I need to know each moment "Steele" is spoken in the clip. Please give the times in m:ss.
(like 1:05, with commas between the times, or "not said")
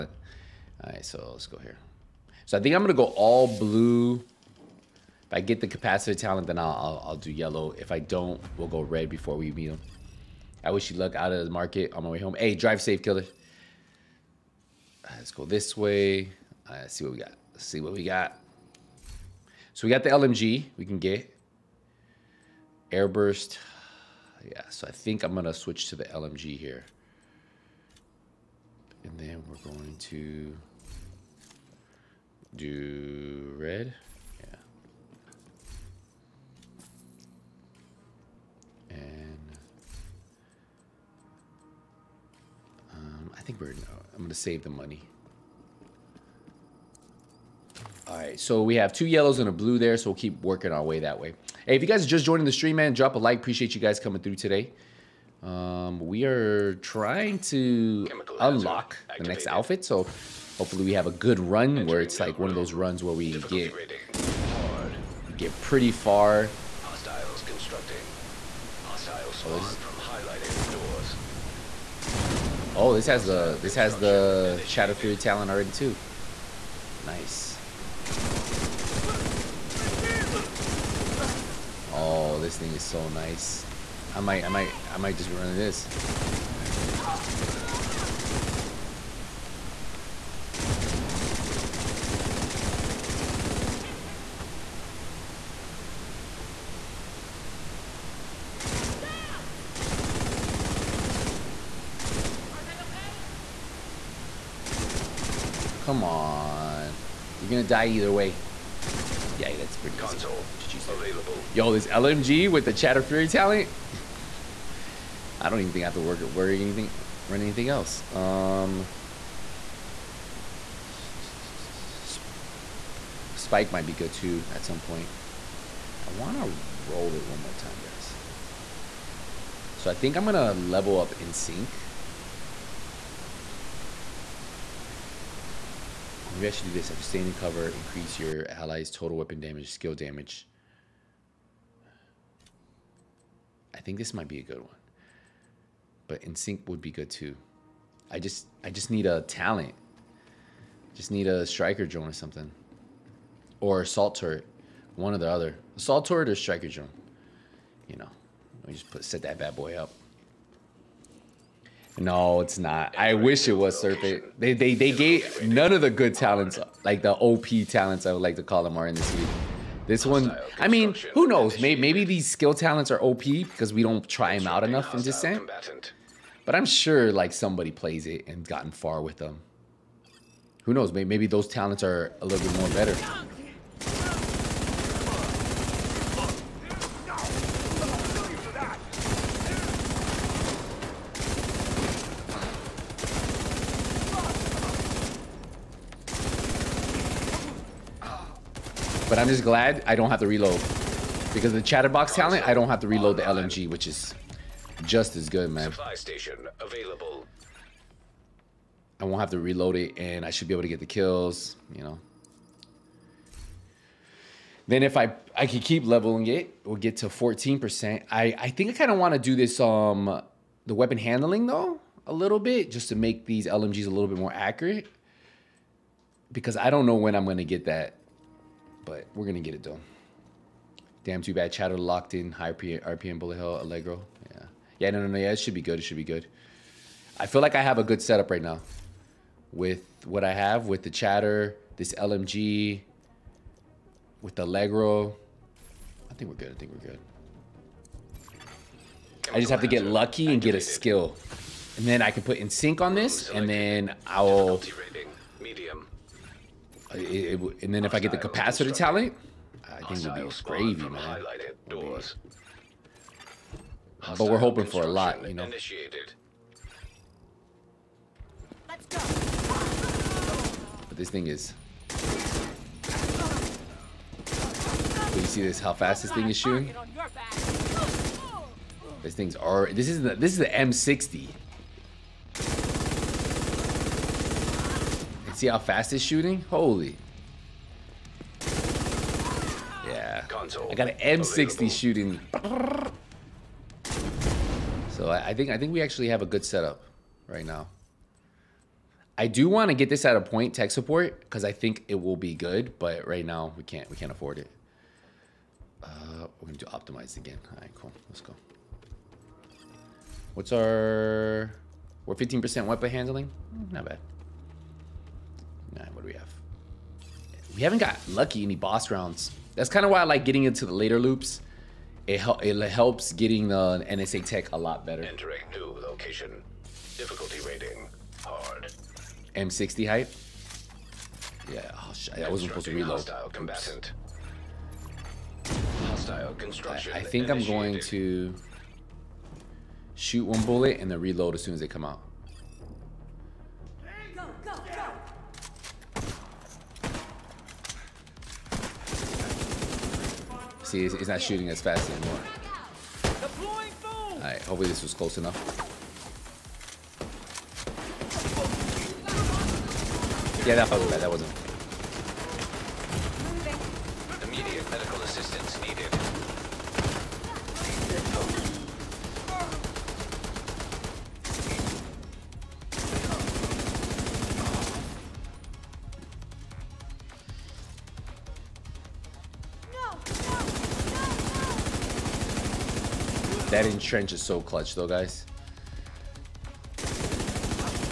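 not said.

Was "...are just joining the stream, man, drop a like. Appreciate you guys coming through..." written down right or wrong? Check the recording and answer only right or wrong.
right.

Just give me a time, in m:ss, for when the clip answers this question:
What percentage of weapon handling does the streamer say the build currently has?
5:12.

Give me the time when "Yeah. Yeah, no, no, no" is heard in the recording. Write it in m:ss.
3:54.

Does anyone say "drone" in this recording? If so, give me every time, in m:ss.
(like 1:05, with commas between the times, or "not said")
2:31, 2:36.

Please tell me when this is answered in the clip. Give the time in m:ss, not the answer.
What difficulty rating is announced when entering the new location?
5:28.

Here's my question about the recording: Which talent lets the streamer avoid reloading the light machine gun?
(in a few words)
chatterbox.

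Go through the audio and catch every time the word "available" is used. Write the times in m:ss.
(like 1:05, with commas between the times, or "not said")
1:50, 3:26.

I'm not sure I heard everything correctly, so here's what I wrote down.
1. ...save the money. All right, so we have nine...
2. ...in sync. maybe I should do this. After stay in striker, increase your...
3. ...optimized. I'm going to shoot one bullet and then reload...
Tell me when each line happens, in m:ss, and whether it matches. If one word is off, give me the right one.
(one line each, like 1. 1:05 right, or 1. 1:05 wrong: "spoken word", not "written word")
1. 0:44 wrong: "two", not "nine"
2. 2:11 wrong: "cover", not "striker"
3. 5:37 wrong: "initiated", not "optimized".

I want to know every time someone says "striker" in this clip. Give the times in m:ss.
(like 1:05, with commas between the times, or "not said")
2:31, 2:36.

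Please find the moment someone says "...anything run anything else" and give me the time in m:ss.
1:56.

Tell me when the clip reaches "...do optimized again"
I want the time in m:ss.
5:06.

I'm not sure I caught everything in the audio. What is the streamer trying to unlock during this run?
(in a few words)
the next outfit.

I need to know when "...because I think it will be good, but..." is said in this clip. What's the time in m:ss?
5:01.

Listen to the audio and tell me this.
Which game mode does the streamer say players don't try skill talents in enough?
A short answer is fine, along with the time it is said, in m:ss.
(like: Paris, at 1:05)
Descent, at 2:55.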